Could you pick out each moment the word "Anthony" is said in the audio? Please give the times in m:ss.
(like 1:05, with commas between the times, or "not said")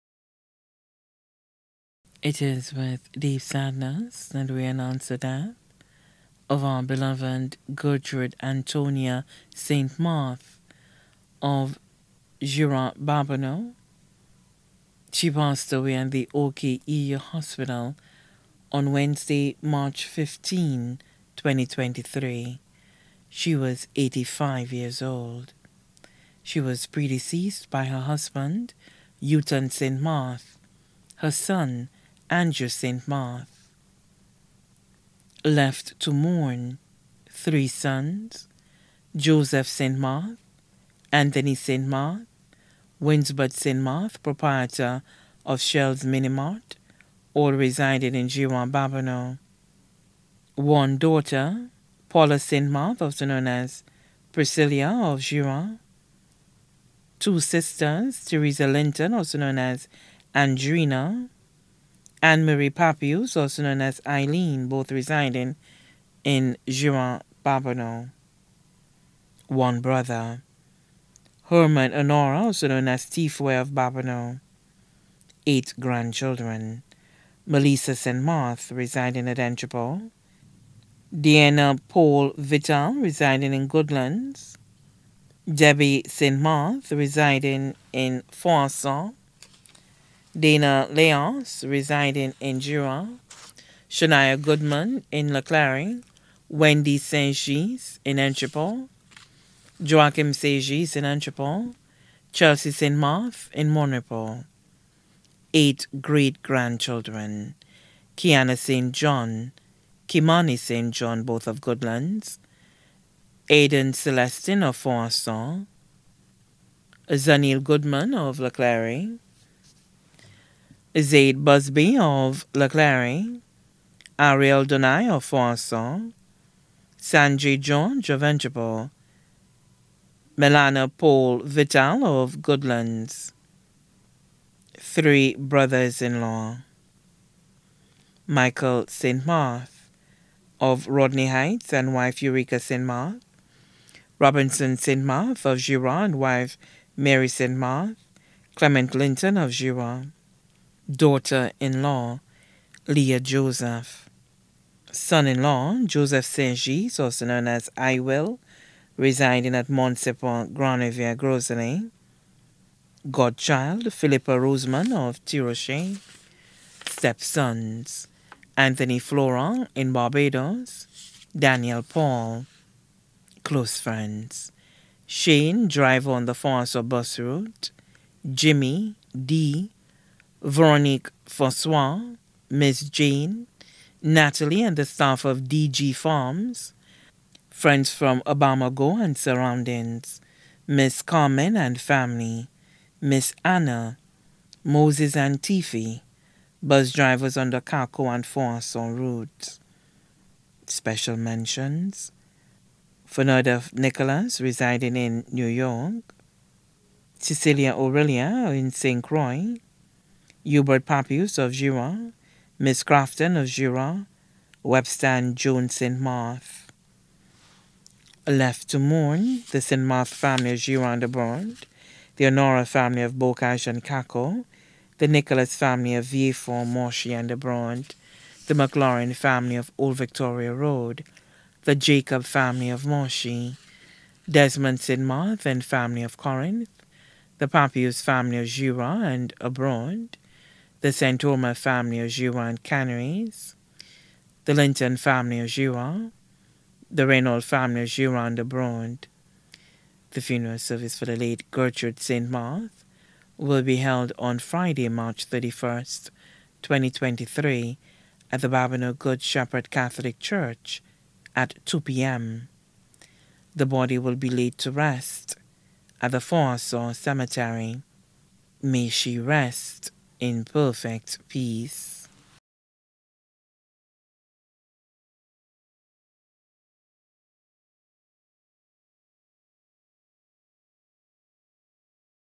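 0:41, 2:48.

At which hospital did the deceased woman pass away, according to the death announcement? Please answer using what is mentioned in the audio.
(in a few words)
OKEU Hospital.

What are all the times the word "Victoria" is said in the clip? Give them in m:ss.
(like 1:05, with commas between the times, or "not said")
3:49.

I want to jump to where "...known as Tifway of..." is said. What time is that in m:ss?
1:12.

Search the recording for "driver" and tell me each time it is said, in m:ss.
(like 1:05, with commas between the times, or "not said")
2:55, 3:16.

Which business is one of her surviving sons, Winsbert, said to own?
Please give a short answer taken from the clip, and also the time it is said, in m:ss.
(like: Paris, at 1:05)
Shell's Mini Mart, at 0:45.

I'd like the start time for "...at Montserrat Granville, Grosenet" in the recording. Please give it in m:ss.
2:39.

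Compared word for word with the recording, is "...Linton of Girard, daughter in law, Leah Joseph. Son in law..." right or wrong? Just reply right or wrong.
right.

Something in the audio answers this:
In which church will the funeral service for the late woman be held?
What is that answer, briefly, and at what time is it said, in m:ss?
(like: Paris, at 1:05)
Babonneau Good Shepherd Catholic Church, at 4:18.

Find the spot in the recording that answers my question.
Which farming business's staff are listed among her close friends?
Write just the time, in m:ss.
3:05.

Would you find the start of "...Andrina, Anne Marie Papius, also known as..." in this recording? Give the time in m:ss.
1:00.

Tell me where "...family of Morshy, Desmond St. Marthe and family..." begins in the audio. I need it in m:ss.
3:52.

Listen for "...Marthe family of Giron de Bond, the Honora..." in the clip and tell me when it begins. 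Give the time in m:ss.
3:39.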